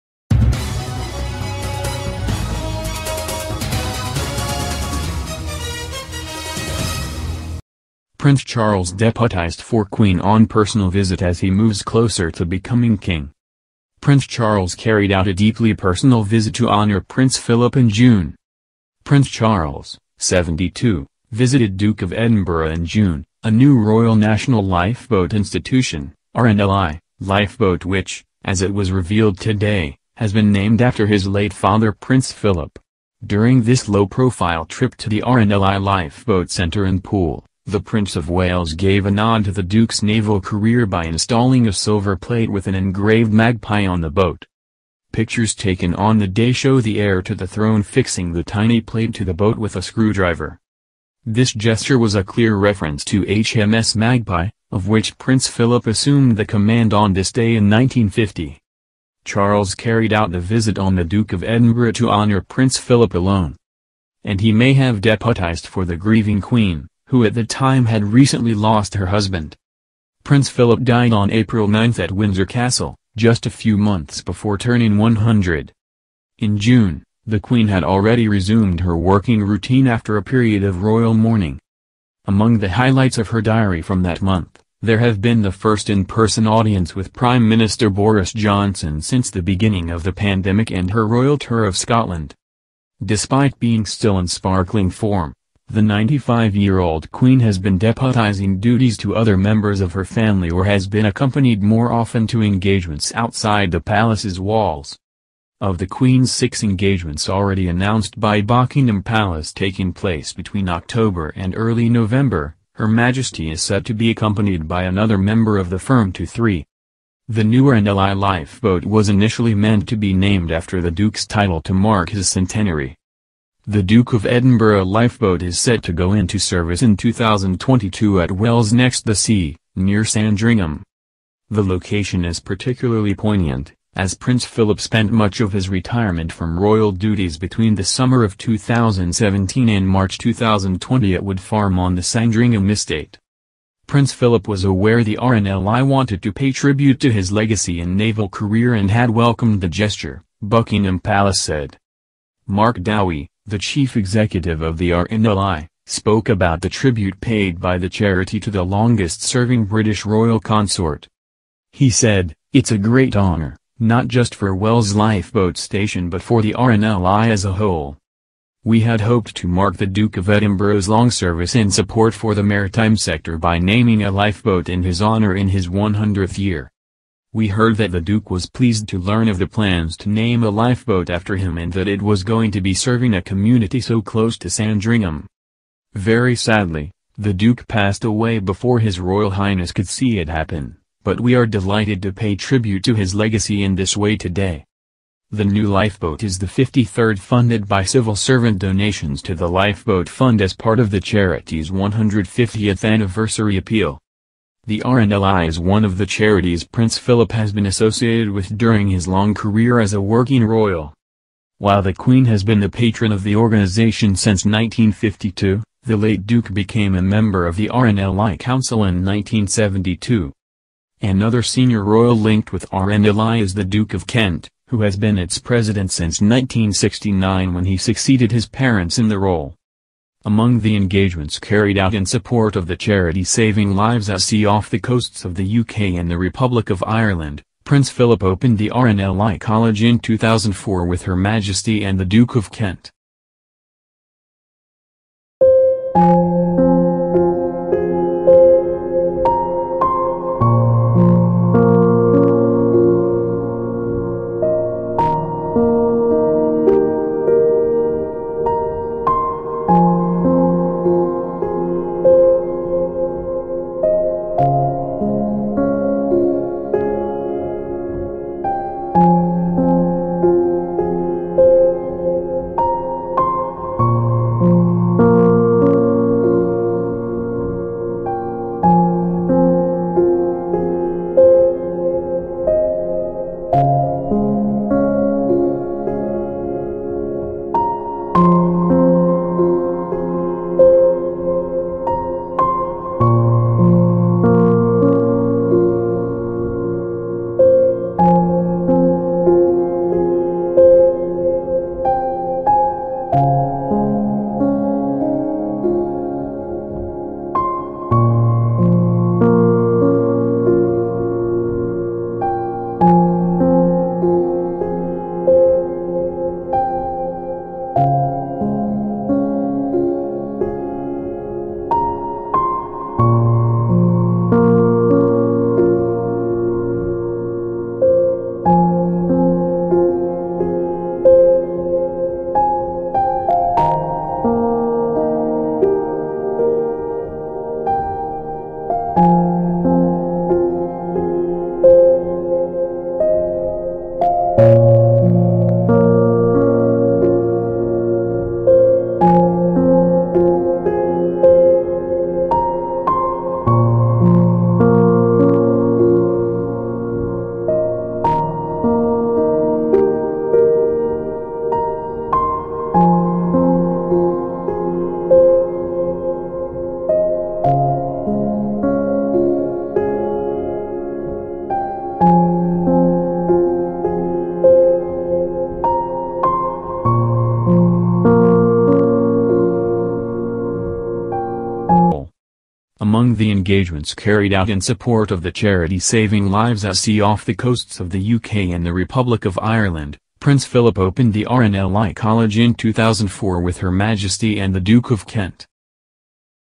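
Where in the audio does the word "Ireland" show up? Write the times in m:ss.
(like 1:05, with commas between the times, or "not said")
3:56, 6:29.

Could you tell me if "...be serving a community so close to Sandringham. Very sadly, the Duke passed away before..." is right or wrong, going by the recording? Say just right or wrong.
right.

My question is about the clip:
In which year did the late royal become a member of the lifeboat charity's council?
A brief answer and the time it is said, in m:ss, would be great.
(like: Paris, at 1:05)
1972, at 3:39.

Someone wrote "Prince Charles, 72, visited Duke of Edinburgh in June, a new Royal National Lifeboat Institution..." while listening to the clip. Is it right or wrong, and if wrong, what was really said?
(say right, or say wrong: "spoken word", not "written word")
right.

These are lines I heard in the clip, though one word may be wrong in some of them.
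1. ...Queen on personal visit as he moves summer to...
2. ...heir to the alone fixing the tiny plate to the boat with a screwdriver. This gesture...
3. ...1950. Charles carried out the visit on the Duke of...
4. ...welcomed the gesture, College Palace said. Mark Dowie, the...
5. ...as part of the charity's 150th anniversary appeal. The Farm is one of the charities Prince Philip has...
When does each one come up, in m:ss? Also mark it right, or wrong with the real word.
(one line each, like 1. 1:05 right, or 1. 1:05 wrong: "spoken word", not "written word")
1. 0:09 wrong: "closer", not "summer"
2. 0:46 wrong: "throne", not "alone"
3. 0:57 right
4. 2:29 wrong: "Buckingham", not "College"
5. 3:20 wrong: "RNLI", not "Farm".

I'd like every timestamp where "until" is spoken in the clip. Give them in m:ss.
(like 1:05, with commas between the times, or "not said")
not said.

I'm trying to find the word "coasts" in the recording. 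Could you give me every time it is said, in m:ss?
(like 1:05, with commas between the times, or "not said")
3:54, 6:27.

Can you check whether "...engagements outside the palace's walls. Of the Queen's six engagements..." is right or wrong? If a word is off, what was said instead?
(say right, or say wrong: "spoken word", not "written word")
right.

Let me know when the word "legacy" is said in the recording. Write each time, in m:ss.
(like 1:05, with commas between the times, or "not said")
2:27, 3:13.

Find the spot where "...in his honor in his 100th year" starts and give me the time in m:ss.
2:54.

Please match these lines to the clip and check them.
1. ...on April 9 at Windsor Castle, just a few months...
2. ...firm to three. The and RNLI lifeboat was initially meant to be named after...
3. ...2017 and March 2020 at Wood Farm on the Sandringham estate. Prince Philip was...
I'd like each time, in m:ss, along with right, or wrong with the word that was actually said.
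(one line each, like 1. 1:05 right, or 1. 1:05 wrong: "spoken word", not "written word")
1. 1:11 right
2. 1:55 right
3. 2:18 right.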